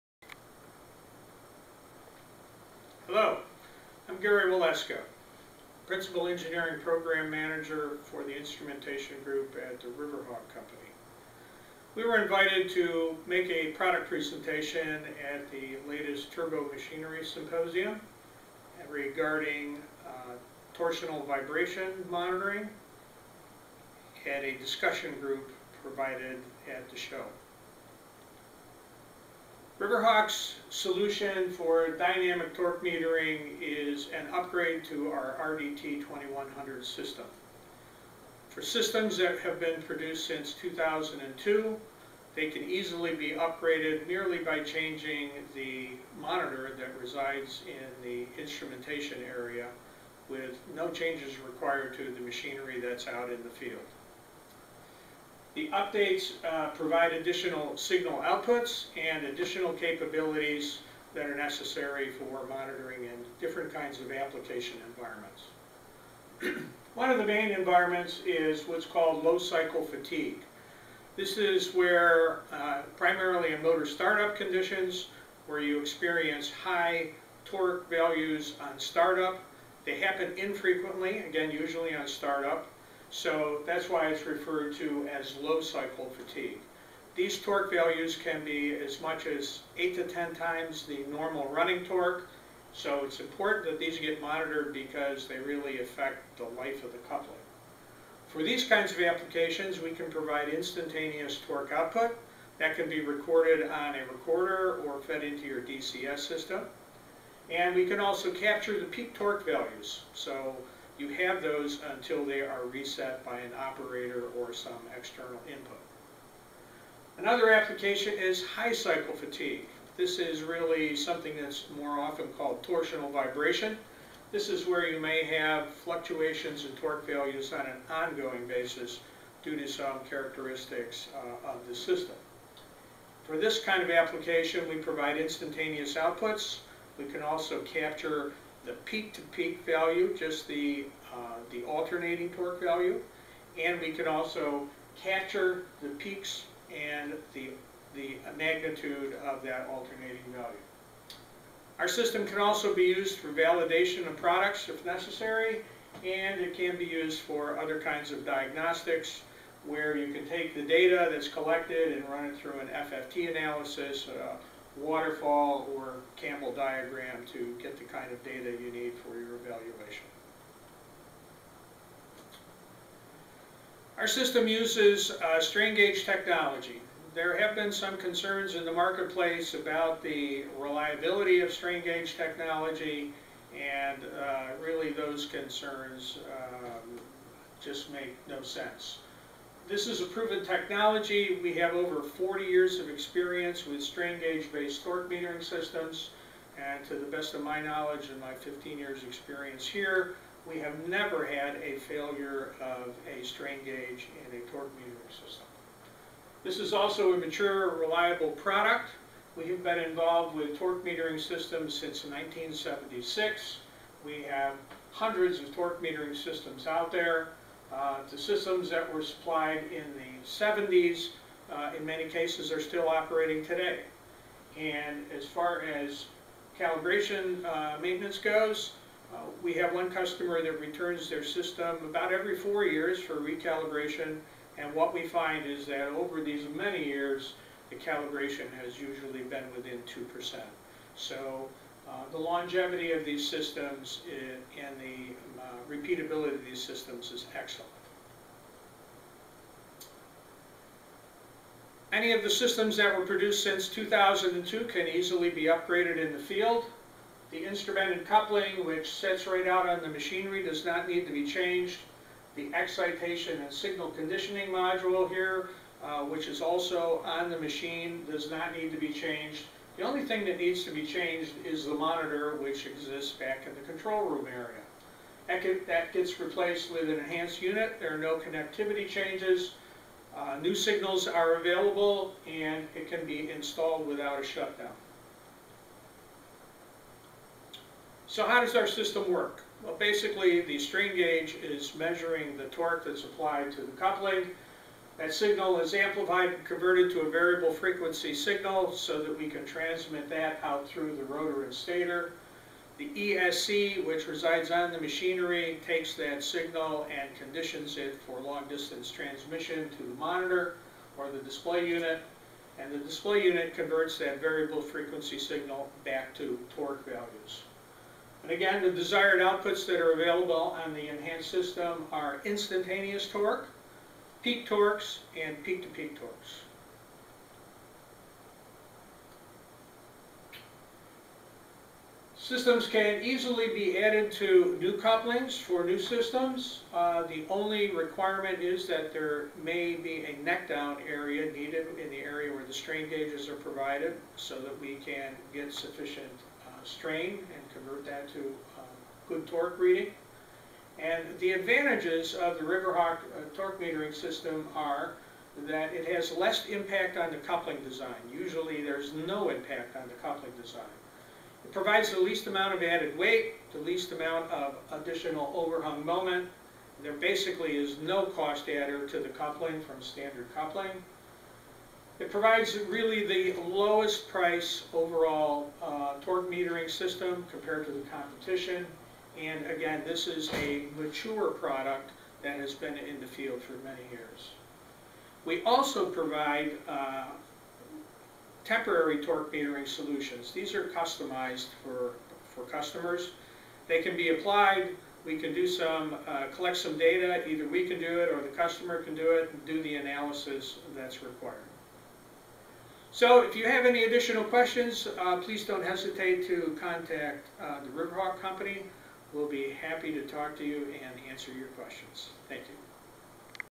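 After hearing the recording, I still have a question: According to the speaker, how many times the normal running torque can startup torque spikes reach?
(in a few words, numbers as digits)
8 to 10.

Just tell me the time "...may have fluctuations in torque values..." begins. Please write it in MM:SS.
02:04.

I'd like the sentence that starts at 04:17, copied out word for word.
The instrumented coupling, which sets right out on the machinery, does not need to be changed.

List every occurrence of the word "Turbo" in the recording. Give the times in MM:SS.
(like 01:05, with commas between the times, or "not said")
00:16.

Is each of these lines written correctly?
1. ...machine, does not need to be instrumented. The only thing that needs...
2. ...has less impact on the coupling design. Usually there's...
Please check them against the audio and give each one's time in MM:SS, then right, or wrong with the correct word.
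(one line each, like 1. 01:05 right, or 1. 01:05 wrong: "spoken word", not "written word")
1. 04:27 wrong: "changed", not "instrumented"
2. 05:55 right.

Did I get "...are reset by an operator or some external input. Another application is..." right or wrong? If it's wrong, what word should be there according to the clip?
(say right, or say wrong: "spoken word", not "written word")
right.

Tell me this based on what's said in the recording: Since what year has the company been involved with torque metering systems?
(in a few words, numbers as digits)
1976.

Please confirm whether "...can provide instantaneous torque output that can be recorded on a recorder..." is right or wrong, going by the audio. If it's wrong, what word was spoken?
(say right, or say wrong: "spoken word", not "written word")
right.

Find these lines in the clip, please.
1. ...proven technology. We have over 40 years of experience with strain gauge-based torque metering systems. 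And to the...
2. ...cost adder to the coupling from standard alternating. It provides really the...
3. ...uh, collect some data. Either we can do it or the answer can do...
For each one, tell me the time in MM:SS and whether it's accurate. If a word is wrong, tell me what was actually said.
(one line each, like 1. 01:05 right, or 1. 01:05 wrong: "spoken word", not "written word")
1. 03:10 right
2. 06:08 wrong: "coupling", not "alternating"
3. 06:36 wrong: "customer", not "answer".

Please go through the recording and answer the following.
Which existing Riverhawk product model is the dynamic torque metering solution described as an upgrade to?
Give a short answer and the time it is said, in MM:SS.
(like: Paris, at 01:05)
RDT 2100, at 00:35.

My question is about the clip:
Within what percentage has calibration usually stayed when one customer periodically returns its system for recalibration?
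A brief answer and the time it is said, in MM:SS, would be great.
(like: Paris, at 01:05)
2%, at 03:59.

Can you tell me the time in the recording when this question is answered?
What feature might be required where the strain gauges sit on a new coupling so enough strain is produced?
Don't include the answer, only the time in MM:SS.
05:40.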